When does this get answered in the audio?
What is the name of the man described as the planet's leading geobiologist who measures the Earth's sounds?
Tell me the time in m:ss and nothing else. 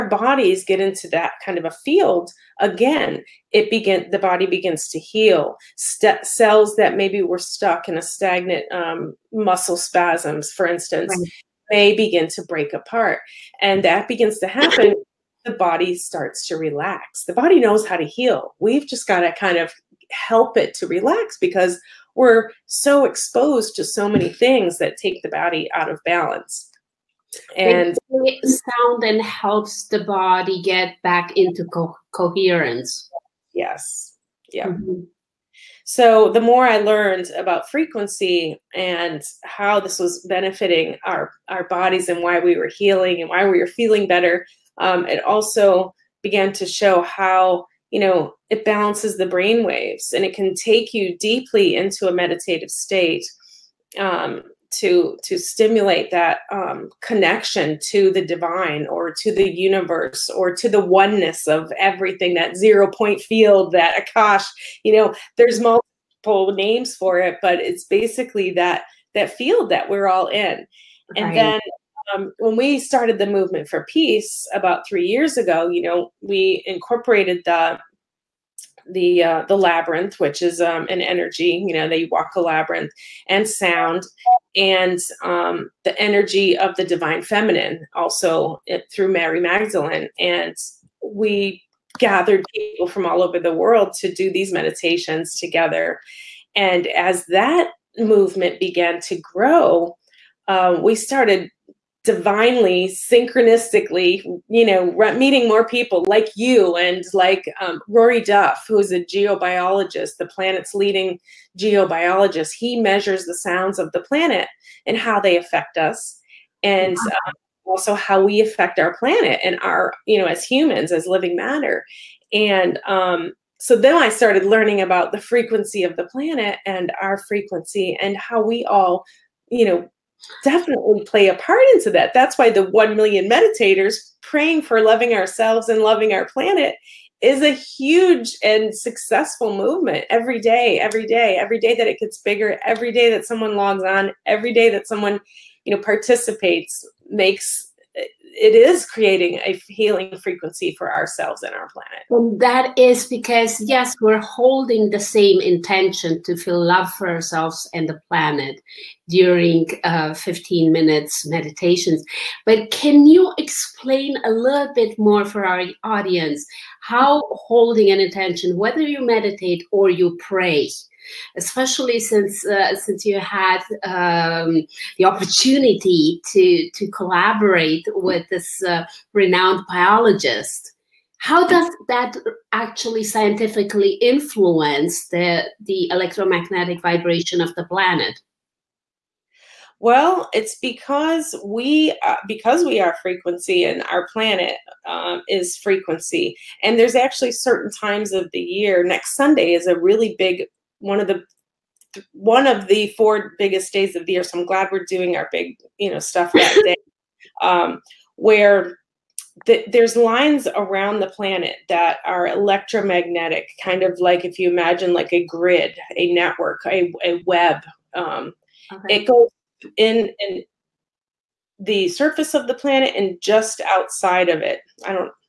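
1:47.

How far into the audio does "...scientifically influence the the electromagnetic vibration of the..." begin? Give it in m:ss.
3:03.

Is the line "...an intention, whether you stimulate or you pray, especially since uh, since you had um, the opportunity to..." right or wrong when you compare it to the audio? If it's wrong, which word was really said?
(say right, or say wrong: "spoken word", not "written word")
wrong: "meditate", not "stimulate".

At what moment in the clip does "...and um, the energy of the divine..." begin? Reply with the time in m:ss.
1:24.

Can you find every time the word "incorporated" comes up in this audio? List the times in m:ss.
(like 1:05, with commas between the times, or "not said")
1:16.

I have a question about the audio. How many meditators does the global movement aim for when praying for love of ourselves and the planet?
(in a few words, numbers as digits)
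1 million.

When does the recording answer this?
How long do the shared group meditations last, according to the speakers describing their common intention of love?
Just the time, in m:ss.
2:40.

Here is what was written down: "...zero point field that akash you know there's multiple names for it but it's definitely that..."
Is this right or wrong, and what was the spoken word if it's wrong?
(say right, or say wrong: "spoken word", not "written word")
wrong: "basically", not "definitely".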